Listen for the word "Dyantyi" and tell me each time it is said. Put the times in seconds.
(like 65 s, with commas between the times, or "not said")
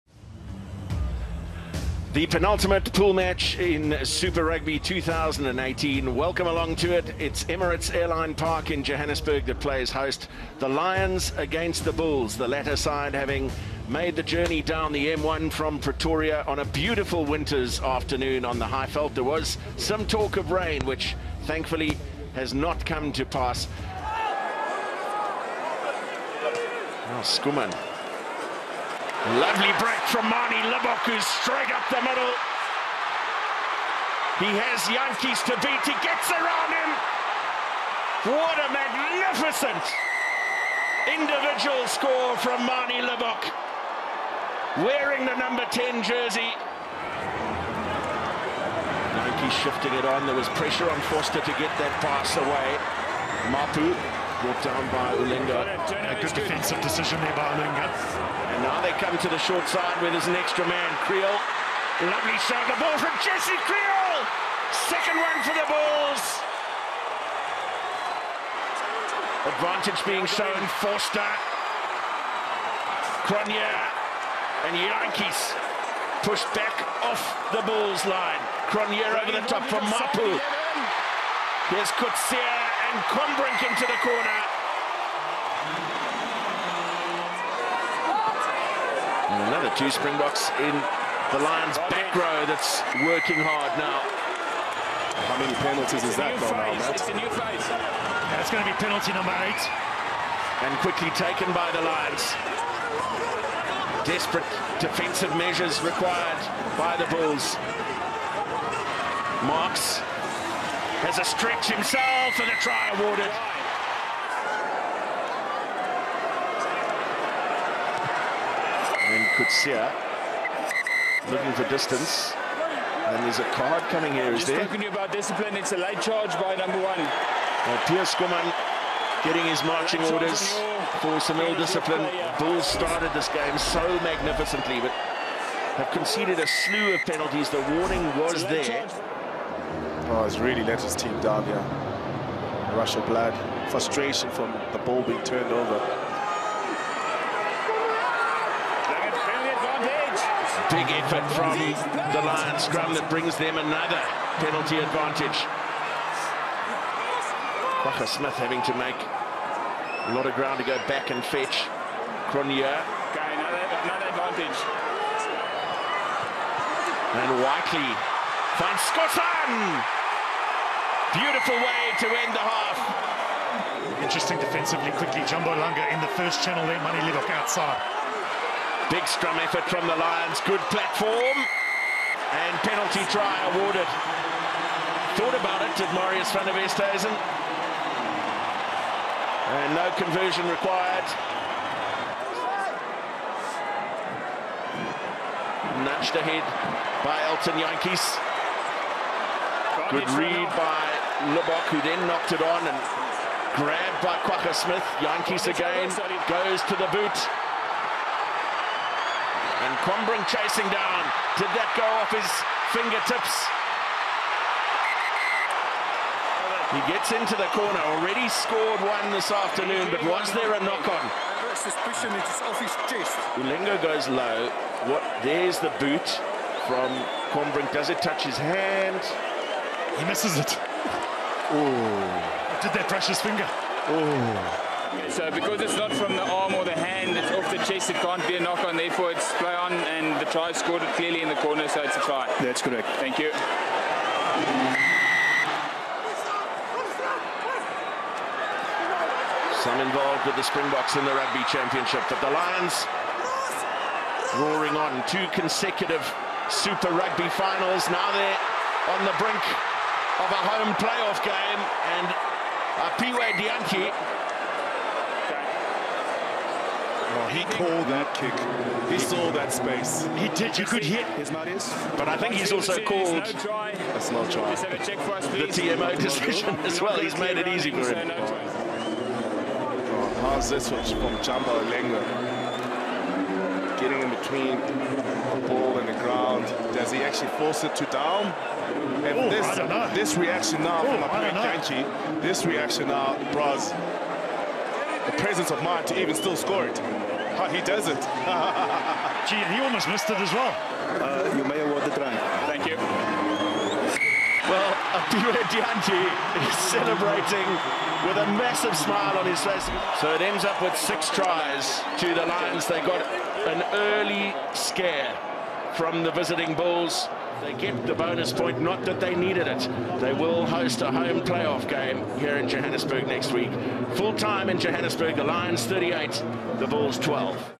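263 s, 291 s, 305 s.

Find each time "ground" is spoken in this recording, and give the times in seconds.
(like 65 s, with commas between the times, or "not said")
160 s, 286 s.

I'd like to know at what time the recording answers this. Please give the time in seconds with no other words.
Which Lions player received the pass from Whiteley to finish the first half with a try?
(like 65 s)
168 s.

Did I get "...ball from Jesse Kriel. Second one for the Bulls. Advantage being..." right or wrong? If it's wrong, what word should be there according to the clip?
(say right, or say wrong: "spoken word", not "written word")
right.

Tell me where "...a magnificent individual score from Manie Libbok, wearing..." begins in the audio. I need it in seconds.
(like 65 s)
38 s.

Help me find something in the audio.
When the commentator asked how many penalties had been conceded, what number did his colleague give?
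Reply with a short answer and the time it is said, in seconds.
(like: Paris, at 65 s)
8, at 99 s.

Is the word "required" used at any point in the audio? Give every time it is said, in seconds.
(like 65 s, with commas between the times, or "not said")
105 s, 190 s.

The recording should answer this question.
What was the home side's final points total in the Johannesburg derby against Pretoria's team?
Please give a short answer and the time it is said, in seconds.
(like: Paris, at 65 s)
38, at 325 s.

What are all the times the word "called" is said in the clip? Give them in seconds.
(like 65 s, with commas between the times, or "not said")
267 s, 272 s.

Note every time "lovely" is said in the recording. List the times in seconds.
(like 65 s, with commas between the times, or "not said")
29 s, 62 s.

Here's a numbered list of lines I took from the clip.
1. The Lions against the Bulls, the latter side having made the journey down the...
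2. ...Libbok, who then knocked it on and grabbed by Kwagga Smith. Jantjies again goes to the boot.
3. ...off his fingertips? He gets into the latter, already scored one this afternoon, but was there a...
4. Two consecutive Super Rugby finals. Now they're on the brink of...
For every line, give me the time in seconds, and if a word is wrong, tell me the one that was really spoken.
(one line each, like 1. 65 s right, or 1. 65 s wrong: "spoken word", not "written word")
1. 10 s right
2. 201 s right
3. 212 s wrong: "corner", not "latter"
4. 255 s right.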